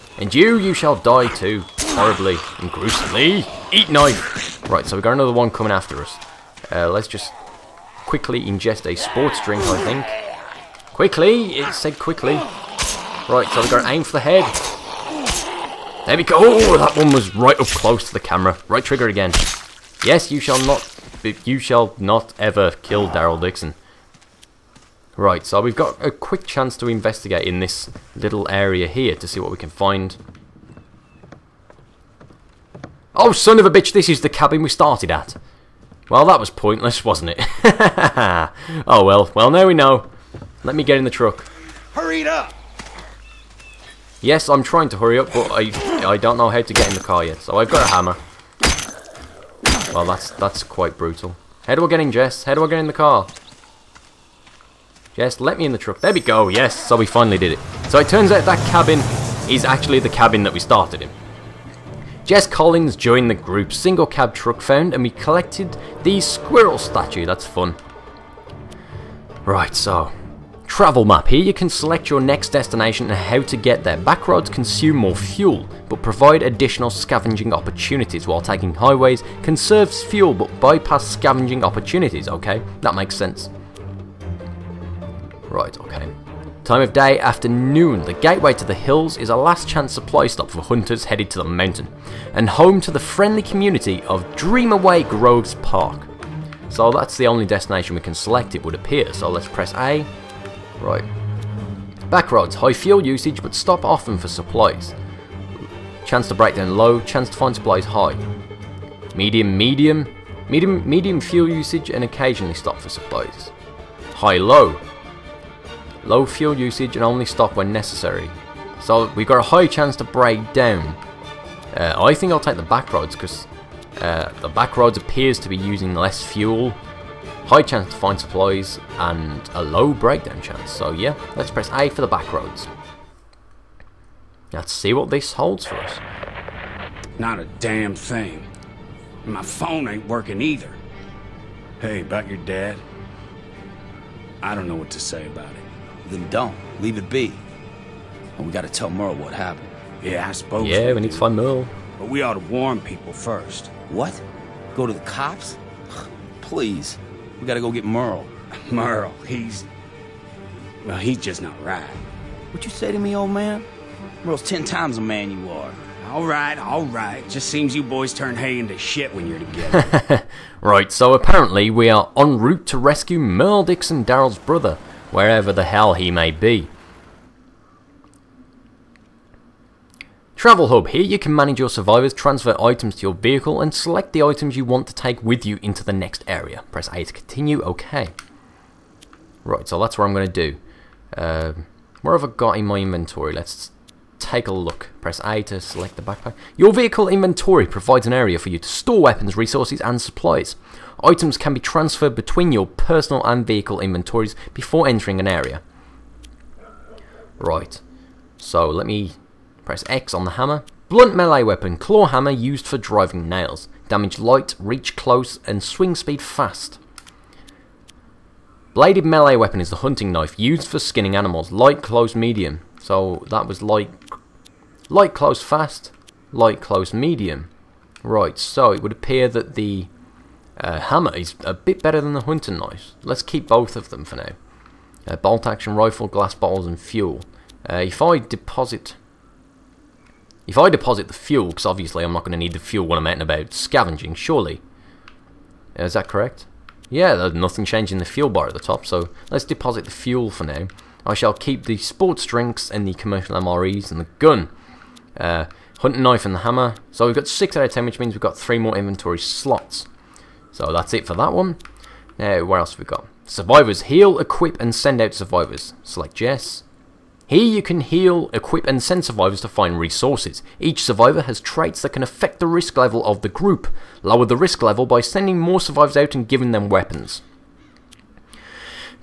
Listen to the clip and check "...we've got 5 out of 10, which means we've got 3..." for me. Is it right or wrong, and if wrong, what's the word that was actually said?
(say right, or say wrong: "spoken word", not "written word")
wrong: "6", not "5".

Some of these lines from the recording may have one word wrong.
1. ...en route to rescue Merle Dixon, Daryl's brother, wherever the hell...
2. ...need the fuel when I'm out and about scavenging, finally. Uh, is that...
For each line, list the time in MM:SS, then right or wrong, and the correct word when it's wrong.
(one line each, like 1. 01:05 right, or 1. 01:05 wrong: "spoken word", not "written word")
1. 02:52 right
2. 04:02 wrong: "surely", not "finally".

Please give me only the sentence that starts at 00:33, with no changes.
Oh, son of a bitch, this is the cabin we started at.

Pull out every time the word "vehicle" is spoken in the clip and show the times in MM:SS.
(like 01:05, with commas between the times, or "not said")
03:03, 03:16, 03:23.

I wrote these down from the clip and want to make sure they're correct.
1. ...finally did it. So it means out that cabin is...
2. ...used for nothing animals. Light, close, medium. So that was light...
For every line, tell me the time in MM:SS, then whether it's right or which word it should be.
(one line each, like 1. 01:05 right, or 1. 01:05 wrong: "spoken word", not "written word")
1. 00:57 wrong: "turns", not "means"
2. 03:40 wrong: "skinning", not "nothing".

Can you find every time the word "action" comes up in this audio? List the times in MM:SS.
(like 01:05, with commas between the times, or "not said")
03:55.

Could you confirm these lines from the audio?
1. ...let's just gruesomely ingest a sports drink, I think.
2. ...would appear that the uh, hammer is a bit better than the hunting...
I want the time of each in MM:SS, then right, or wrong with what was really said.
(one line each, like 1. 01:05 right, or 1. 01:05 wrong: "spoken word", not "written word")
1. 00:06 wrong: "quickly", not "gruesomely"
2. 03:48 right.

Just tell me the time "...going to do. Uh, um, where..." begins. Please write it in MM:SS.
03:10.